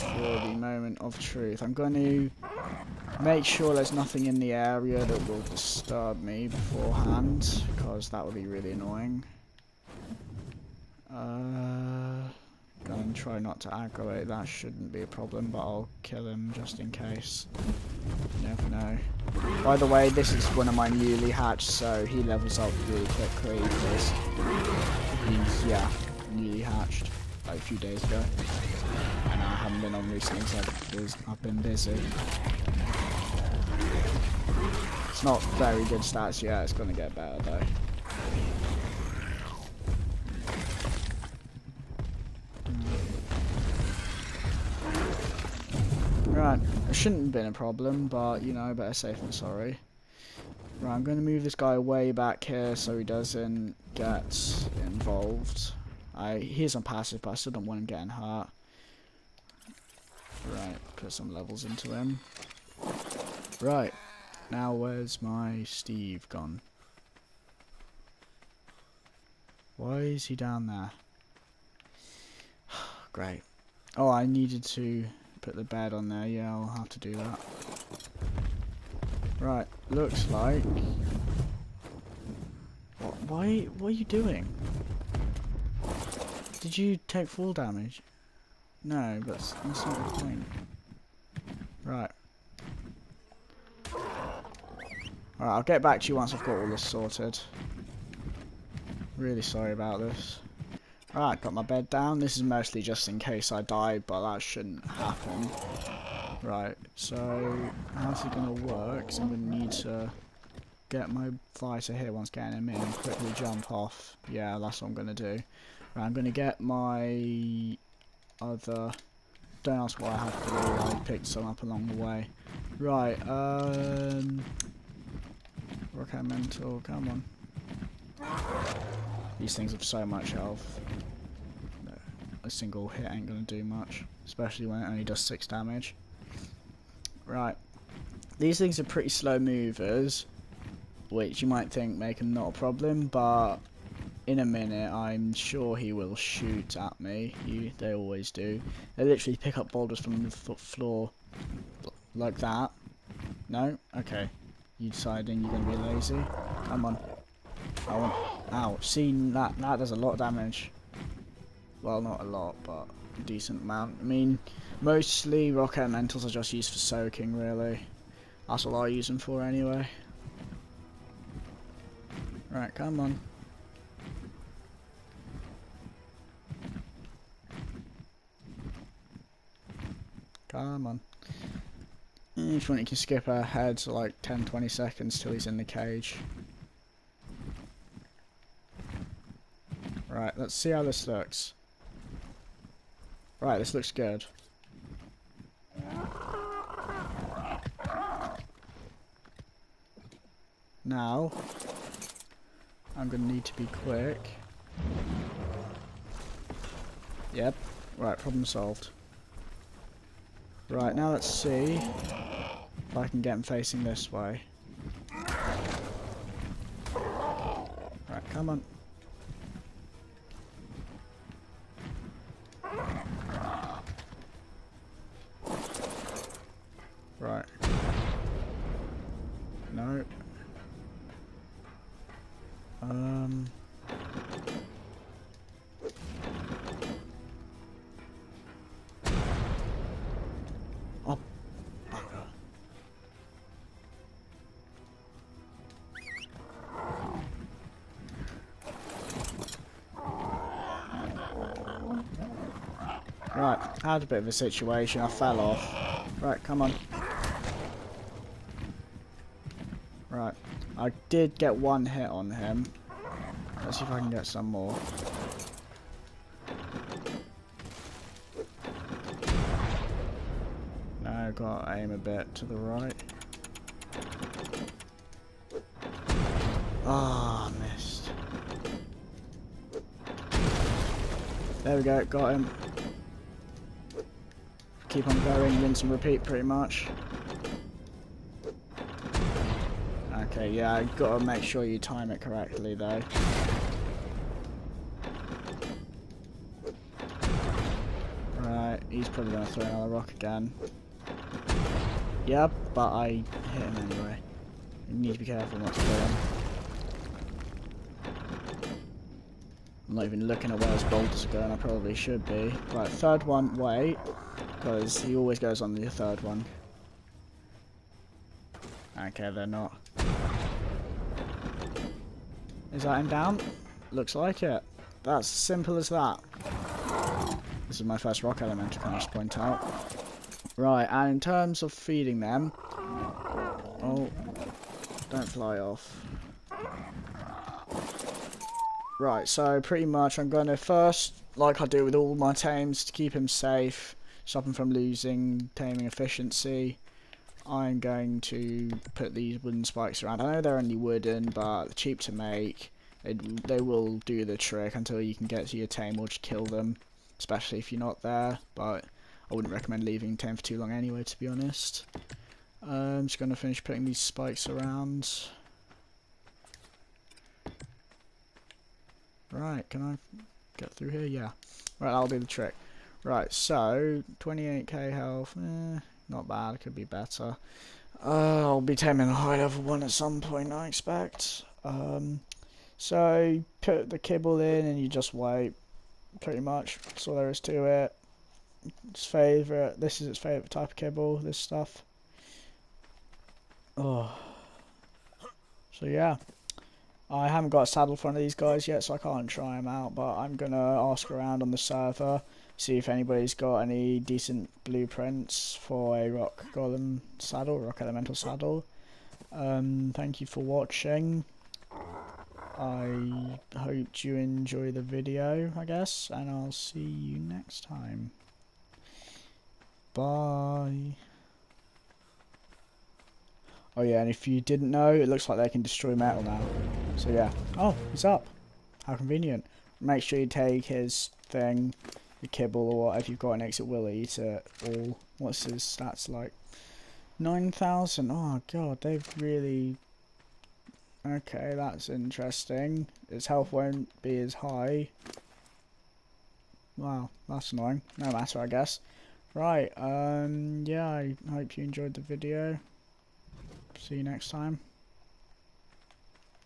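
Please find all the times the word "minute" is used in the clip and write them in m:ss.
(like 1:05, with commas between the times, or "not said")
2:24.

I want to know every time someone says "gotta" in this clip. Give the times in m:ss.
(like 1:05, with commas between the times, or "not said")
4:50.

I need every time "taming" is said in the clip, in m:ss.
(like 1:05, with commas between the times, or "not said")
5:45, 6:18.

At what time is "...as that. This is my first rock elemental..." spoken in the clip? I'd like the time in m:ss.
5:25.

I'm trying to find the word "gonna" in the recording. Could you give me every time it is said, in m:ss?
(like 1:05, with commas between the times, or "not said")
0:36, 2:13, 4:59.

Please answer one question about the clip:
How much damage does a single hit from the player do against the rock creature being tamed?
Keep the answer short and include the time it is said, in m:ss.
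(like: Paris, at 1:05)
6, at 2:15.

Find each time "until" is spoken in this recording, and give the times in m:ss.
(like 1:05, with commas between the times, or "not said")
5:54.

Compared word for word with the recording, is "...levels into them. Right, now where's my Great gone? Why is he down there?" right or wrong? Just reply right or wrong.
wrong.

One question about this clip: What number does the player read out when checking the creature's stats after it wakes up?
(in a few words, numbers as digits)
9,000.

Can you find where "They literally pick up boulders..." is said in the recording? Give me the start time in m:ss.
2:28.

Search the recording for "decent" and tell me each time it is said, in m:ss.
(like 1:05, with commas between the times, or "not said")
2:43, 6:43.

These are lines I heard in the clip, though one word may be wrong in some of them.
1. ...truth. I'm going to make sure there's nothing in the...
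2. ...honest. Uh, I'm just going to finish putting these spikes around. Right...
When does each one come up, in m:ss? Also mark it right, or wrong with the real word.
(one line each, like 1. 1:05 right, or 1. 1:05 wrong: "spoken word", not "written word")
1. 0:01 right
2. 6:01 right.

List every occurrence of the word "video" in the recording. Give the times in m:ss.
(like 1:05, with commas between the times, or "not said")
6:54, 7:31.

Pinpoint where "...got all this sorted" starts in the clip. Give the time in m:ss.
1:36.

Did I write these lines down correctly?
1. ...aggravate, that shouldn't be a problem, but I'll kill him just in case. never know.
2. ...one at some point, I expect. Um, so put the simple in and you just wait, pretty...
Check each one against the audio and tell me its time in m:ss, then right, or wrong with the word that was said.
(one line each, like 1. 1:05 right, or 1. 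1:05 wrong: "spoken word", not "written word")
1. 0:13 right
2. 6:19 wrong: "kibble", not "simple".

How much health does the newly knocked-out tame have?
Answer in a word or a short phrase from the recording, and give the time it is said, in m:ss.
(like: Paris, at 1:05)
28k, at 6:14.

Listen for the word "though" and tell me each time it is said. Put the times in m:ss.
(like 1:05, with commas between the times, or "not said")
0:37, 4:52.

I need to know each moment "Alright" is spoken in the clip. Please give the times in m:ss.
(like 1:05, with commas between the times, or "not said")
1:33, 1:41.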